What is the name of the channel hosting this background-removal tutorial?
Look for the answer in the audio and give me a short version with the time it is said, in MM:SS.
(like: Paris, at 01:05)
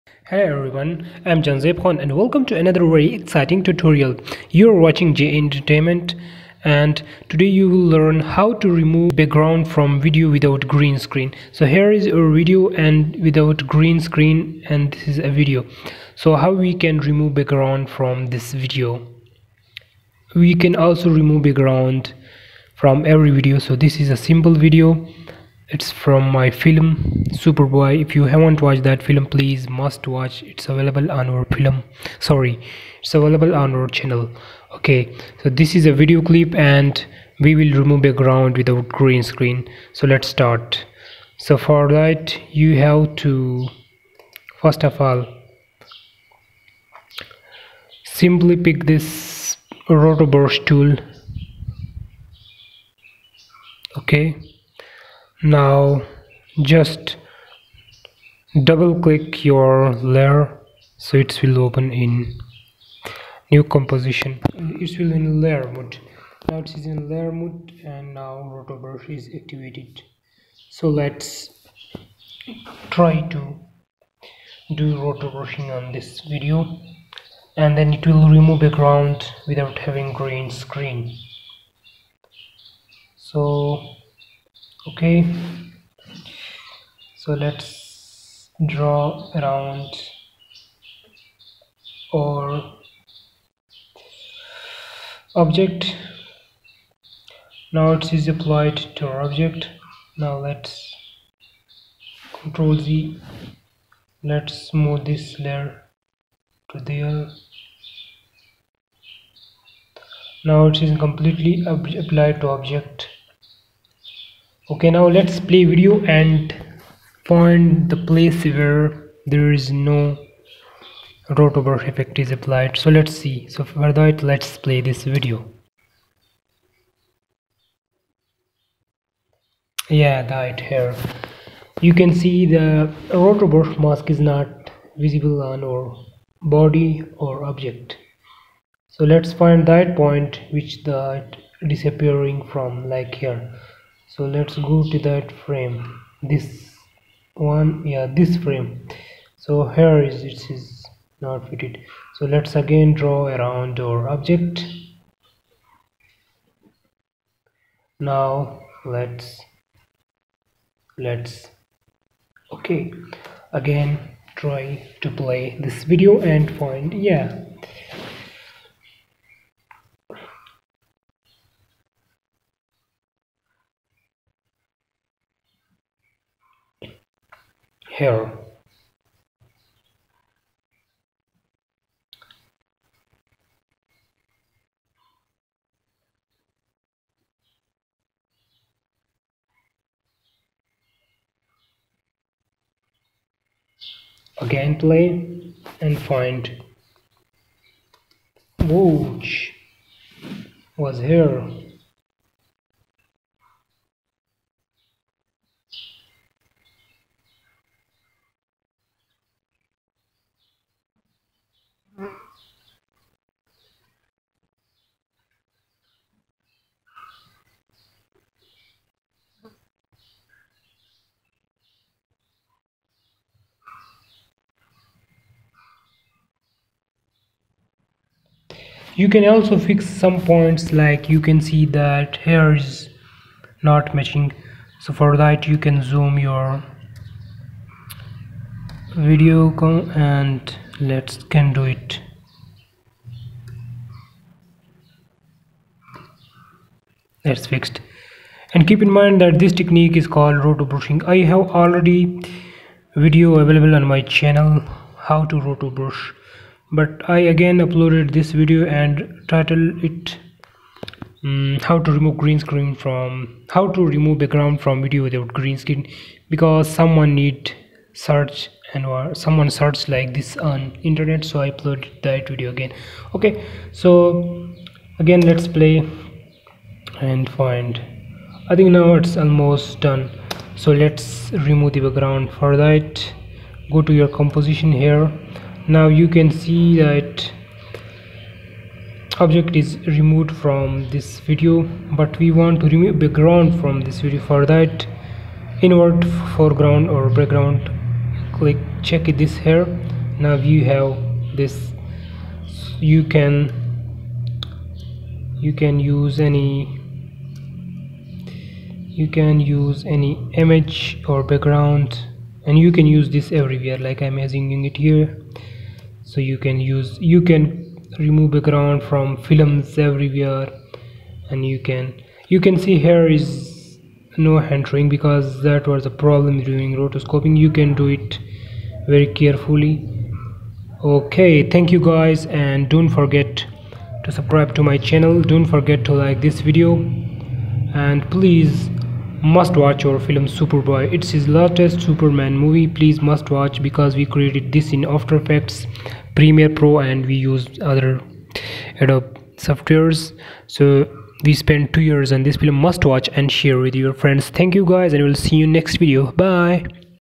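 JA Entertainment, at 00:05.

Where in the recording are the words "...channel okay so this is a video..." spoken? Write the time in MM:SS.
00:33.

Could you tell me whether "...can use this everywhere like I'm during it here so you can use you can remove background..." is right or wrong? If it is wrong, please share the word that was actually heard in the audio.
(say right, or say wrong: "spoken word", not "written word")
wrong: "using", not "during".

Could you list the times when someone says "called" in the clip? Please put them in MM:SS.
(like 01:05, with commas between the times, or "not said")
04:10.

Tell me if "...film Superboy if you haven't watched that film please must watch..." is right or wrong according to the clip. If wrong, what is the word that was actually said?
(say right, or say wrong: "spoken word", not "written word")
right.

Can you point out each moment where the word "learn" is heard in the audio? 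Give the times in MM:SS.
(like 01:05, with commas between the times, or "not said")
00:07.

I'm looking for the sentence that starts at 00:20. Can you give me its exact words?
We can also remove background from every video.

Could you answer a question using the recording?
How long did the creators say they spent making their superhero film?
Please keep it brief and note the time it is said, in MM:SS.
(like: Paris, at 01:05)
2 years, at 05:51.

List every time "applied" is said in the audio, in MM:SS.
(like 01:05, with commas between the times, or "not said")
01:38, 01:51, 02:02.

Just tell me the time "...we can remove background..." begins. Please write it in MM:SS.
00:16.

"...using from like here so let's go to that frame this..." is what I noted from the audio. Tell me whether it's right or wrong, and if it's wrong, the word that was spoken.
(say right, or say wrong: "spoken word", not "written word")
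wrong: "disappearing", not "using".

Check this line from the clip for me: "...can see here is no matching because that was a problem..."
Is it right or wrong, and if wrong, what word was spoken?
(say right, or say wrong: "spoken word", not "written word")
wrong: "entering", not "matching".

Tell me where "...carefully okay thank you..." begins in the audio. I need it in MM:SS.
05:29.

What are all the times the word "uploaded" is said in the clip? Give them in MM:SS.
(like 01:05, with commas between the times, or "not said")
04:17, 04:31.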